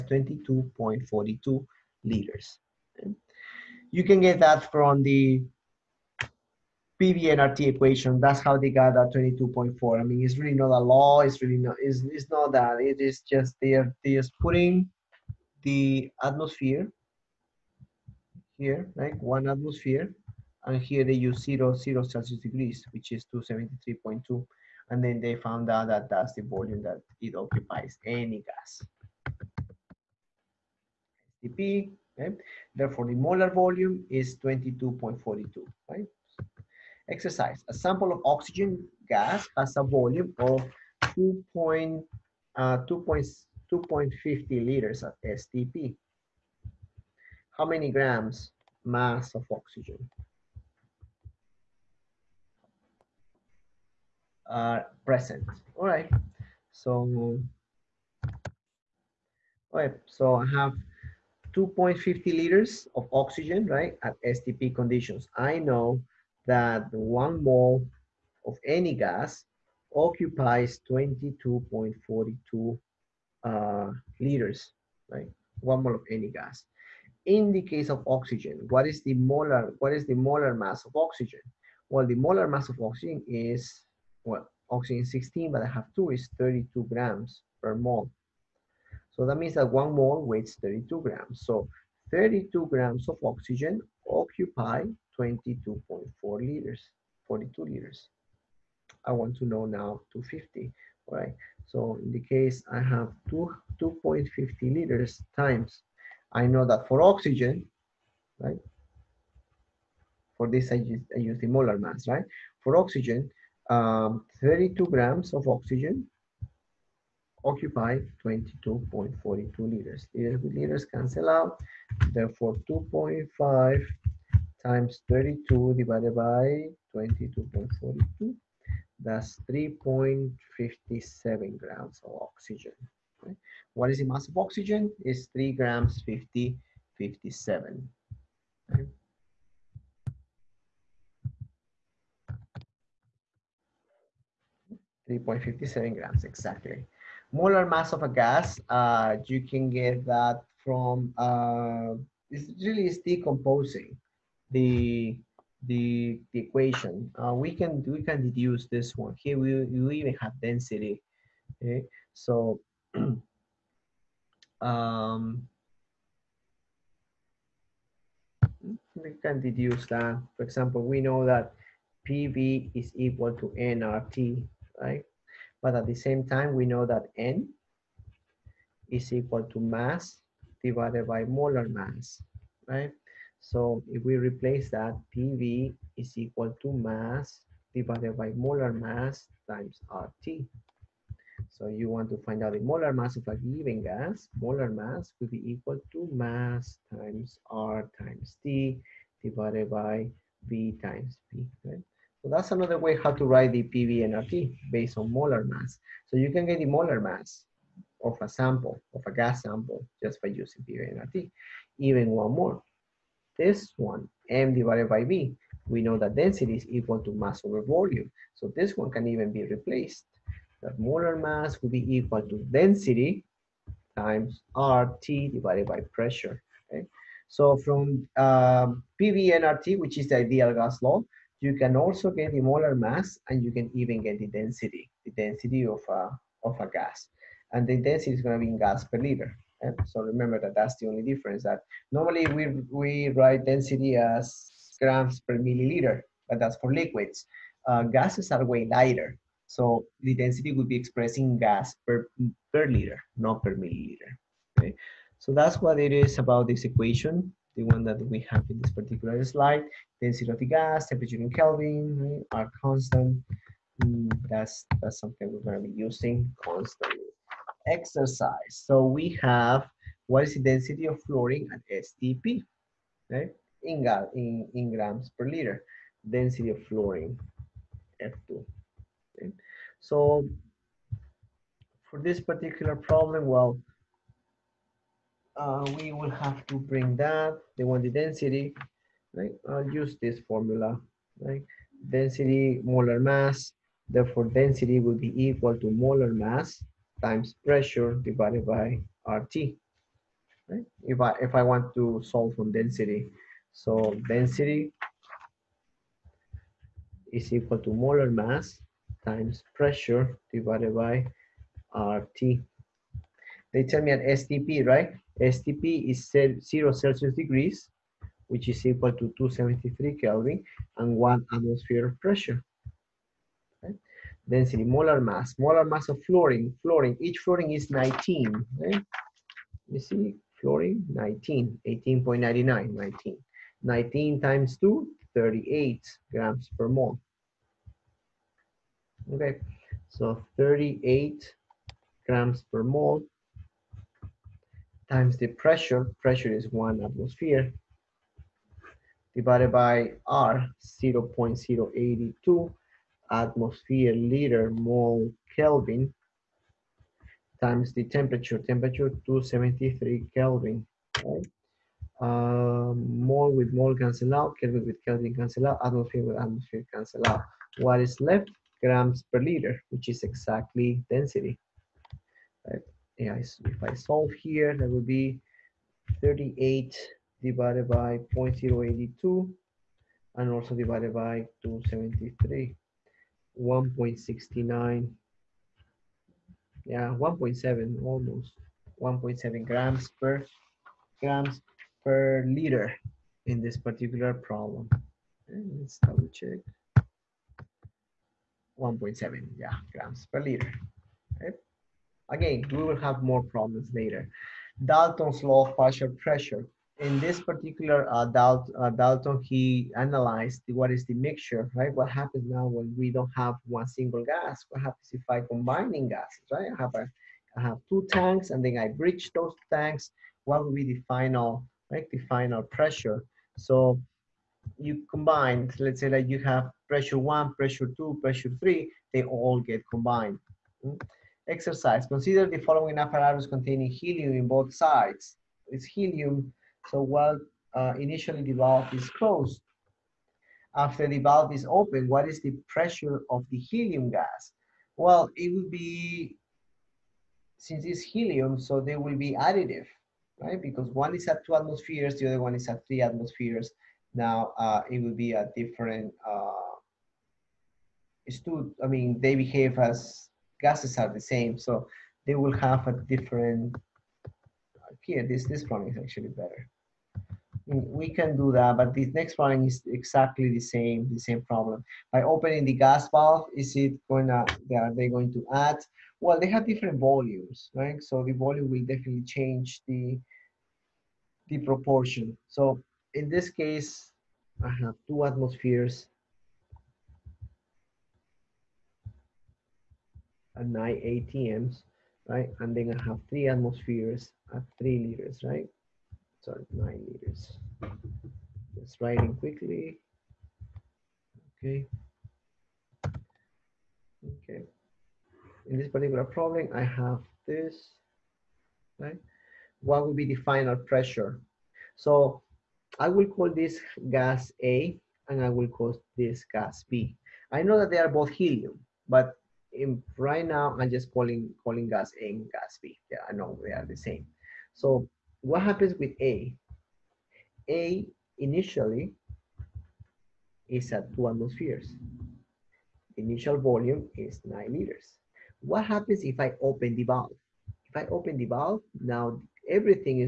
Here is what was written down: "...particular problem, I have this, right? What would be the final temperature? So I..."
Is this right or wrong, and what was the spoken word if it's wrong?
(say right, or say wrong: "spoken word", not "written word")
wrong: "pressure", not "temperature".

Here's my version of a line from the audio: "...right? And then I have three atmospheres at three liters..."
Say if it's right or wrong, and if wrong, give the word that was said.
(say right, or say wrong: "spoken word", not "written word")
right.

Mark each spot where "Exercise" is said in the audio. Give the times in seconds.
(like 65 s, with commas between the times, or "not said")
37 s, 267 s, 431 s.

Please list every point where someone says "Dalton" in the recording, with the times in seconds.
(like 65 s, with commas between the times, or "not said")
404 s, 408 s.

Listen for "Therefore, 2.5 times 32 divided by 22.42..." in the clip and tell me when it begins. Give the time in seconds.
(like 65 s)
122 s.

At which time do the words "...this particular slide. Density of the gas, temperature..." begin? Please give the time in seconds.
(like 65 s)
258 s.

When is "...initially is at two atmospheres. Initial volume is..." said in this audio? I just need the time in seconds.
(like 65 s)
528 s.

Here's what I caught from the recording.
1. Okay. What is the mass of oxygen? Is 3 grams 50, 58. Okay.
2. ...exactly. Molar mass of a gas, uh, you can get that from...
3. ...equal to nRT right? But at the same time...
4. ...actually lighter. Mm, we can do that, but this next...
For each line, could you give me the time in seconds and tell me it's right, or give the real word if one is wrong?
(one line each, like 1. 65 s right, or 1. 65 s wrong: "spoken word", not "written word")
1. 133 s wrong: "57", not "58"
2. 146 s right
3. 172 s right
4. 465 s wrong: "better", not "lighter".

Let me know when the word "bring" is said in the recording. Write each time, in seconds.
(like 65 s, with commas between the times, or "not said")
286 s.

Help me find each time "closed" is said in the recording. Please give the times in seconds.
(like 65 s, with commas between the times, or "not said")
438 s.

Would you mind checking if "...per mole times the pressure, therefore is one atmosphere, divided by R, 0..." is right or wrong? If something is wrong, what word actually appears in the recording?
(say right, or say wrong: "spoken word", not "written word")
wrong: "pressure", not "therefore".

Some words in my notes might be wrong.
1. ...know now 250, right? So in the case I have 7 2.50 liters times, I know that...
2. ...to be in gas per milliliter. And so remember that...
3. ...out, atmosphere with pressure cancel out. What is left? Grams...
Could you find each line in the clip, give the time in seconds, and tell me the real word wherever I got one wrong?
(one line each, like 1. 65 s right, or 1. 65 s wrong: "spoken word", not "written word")
1. 99 s wrong: "2", not "7"
2. 238 s wrong: "liter", not "milliliter"
3. 365 s wrong: "atmosphere", not "pressure".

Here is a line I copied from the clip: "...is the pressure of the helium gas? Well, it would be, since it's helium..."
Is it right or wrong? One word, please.
right.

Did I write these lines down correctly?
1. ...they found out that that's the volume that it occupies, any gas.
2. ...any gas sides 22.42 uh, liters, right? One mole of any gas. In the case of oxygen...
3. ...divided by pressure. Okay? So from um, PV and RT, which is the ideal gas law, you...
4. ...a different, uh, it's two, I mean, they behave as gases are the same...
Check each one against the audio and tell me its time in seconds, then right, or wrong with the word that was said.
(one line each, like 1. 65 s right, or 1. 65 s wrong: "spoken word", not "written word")
1. 25 s right
2. 68 s wrong: "occupies", not "sides"
3. 225 s right
4. 455 s right.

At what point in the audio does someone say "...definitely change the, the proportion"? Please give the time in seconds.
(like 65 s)
478 s.